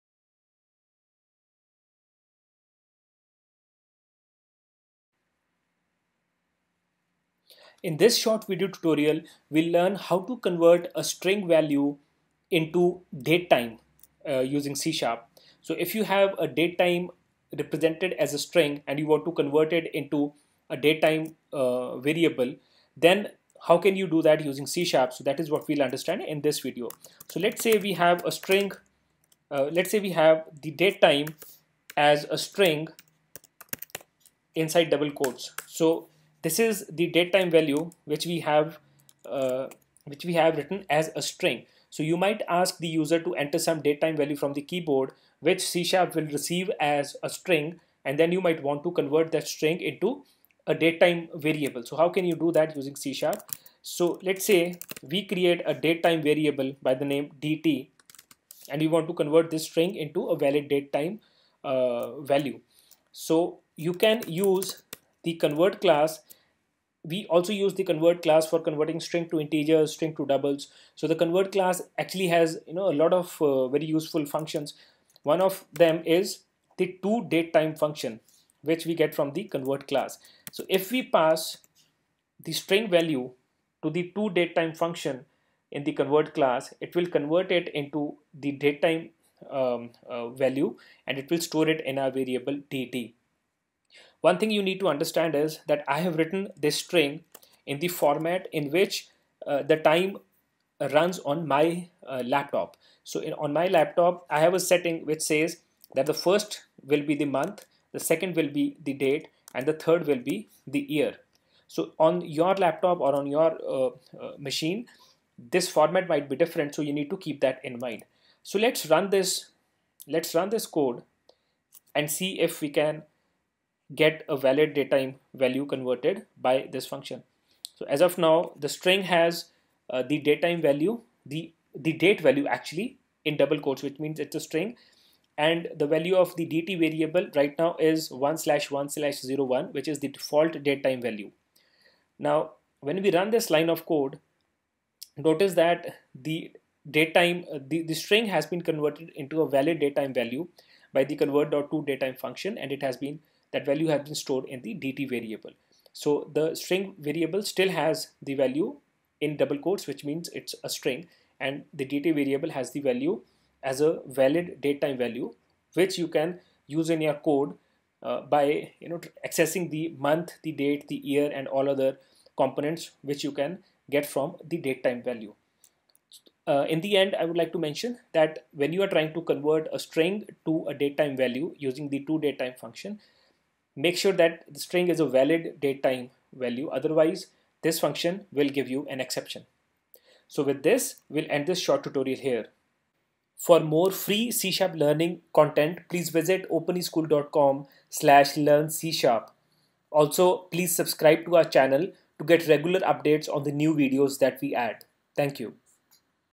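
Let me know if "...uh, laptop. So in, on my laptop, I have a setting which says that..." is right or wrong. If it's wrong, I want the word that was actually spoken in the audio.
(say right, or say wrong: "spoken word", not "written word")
right.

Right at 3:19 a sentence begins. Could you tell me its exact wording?
Also, please subscribe to our channel to get regular updates on the new videos that we add.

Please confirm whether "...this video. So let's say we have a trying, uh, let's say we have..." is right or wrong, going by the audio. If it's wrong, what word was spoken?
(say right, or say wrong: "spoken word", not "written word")
wrong: "string", not "trying".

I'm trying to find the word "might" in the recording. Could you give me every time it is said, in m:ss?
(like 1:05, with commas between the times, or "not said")
0:42, 0:48, 1:56.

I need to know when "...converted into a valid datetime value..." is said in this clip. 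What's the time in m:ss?
2:28.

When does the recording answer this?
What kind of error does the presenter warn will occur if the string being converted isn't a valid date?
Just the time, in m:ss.
3:08.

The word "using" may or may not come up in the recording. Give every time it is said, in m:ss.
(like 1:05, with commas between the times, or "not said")
0:14, 0:24, 0:52, 3:01.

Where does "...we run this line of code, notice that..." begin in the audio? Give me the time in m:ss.
2:23.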